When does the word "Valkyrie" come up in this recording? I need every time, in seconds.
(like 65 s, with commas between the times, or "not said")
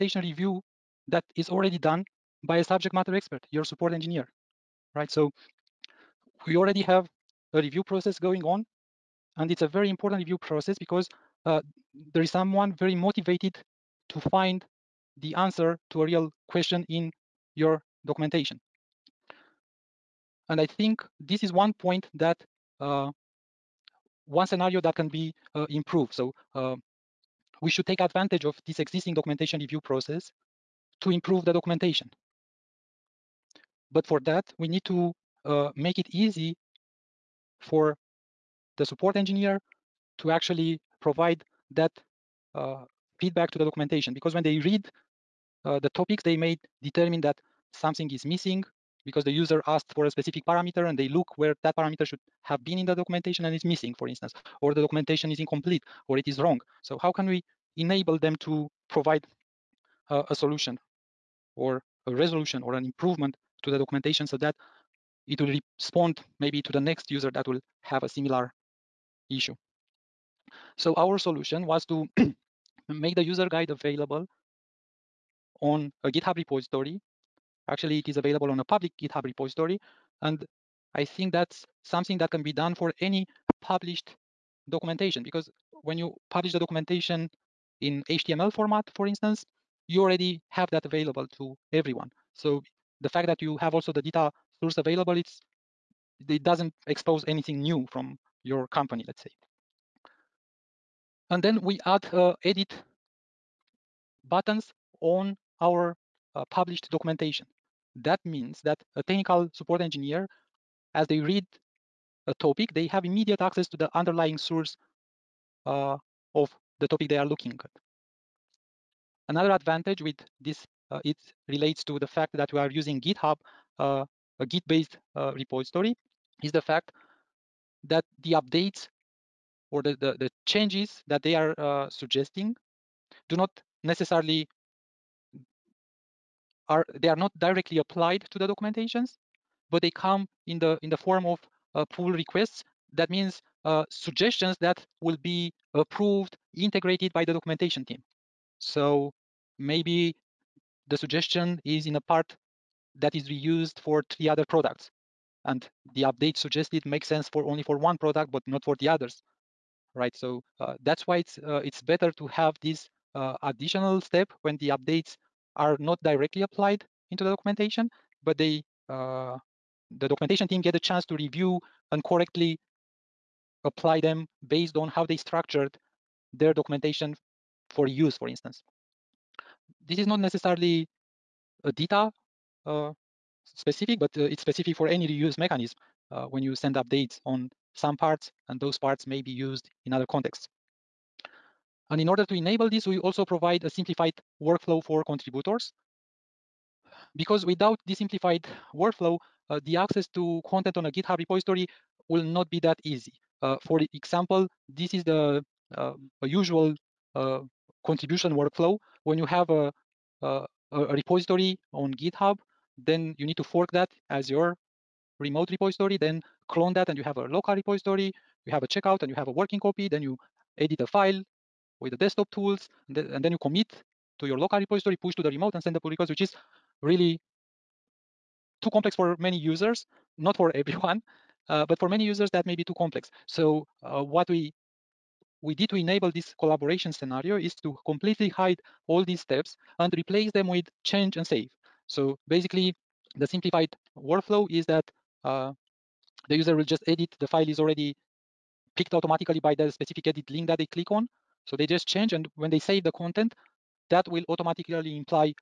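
not said.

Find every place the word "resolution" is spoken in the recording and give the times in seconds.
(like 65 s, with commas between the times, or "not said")
62 s.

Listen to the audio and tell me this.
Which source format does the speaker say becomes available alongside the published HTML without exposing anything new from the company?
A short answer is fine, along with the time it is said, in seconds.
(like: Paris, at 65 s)
DITA source, at 94 s.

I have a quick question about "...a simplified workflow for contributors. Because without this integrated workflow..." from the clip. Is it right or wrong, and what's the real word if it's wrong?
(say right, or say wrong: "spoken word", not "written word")
wrong: "simplified", not "integrated".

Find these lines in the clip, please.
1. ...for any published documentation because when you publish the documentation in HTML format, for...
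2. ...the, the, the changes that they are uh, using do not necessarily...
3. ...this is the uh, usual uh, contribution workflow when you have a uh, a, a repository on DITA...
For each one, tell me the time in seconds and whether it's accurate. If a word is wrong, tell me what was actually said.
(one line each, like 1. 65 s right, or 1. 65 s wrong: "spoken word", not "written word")
1. 82 s right
2. 129 s wrong: "suggesting", not "using"
3. 204 s wrong: "GitHub", not "DITA".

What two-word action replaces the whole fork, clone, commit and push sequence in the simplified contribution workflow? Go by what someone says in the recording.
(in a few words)
change and save.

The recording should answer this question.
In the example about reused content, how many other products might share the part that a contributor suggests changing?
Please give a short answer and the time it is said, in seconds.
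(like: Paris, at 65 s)
3, at 154 s.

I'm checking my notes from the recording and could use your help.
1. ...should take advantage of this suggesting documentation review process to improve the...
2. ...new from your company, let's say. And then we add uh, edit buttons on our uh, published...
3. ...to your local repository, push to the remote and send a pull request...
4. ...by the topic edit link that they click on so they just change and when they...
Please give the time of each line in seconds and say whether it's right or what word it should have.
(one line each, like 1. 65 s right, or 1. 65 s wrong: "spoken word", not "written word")
1. 27 s wrong: "existing", not "suggesting"
2. 97 s right
3. 224 s right
4. 249 s wrong: "specific", not "topic".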